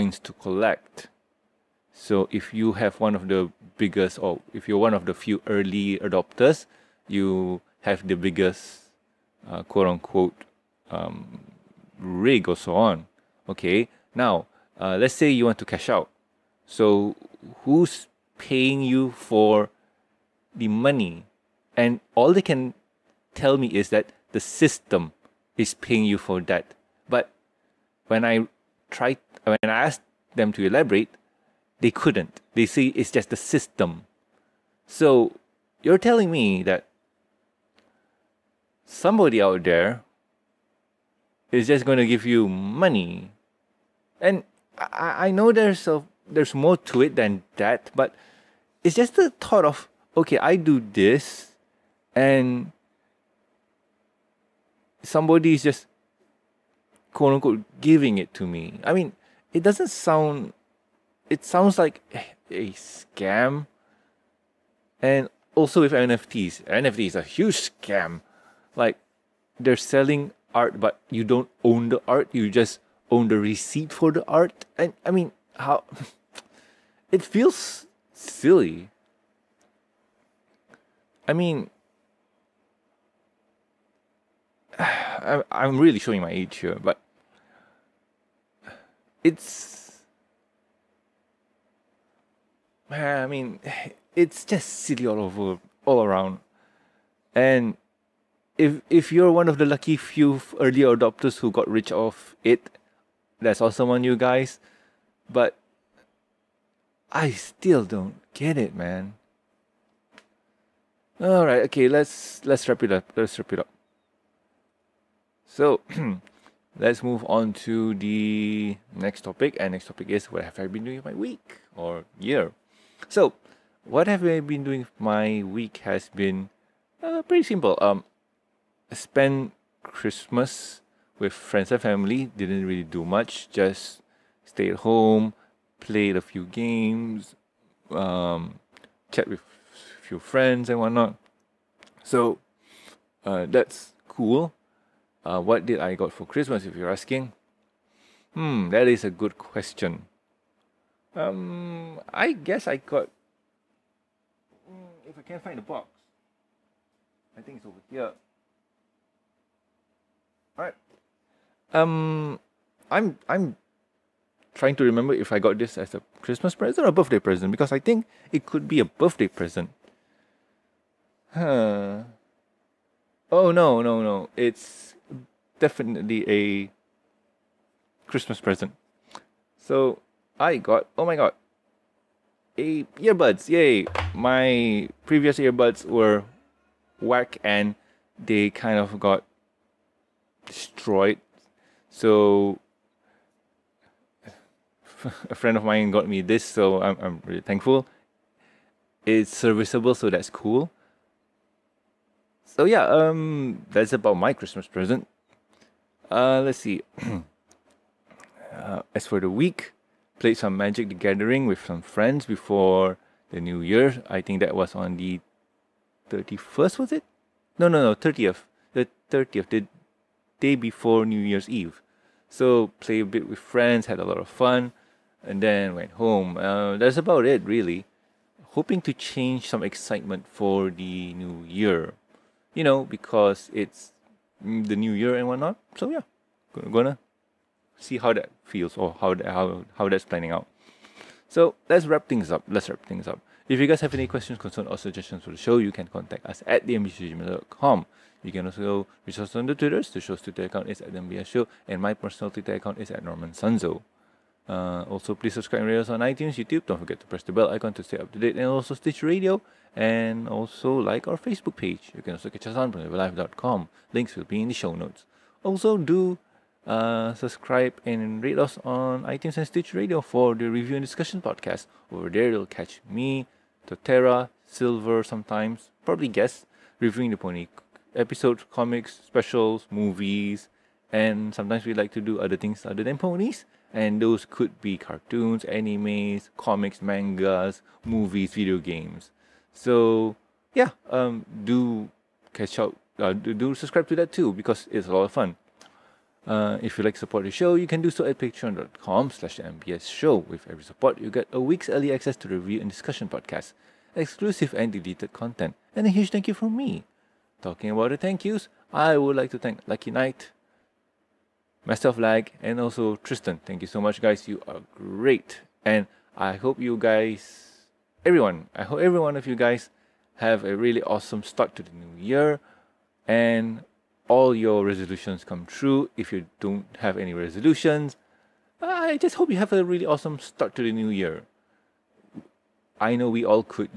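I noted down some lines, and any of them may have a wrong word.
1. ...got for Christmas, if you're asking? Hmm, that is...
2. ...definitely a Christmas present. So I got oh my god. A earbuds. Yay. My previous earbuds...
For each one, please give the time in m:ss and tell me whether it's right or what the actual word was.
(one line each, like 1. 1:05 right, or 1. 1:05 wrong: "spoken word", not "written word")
1. 2:25 right
2. 2:55 right.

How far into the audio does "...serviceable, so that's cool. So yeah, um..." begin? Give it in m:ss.
3:19.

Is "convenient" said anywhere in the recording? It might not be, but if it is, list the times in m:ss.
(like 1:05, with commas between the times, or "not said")
not said.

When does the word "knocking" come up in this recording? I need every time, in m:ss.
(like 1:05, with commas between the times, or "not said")
not said.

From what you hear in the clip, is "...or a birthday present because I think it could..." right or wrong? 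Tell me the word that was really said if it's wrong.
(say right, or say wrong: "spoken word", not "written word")
right.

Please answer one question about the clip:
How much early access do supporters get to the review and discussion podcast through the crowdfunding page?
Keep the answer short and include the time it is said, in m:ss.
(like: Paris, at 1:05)
A week, at 5:01.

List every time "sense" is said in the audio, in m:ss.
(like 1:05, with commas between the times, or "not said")
not said.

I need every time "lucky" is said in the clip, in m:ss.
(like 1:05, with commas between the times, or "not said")
1:39, 5:09.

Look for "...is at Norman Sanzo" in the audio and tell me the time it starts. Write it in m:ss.
4:12.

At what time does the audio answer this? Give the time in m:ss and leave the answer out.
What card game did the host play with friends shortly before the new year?
3:30.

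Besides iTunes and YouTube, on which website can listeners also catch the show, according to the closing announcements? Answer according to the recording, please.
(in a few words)
PonyvilleLive.com.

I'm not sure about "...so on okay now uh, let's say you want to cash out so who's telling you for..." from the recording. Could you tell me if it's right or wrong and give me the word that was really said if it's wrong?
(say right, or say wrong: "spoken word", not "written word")
wrong: "paying", not "telling".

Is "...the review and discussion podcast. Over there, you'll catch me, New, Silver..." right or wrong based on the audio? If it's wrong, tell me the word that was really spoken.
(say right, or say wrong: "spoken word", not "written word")
wrong: "Totera", not "New".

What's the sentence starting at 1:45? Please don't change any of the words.
But I still don't get it, man.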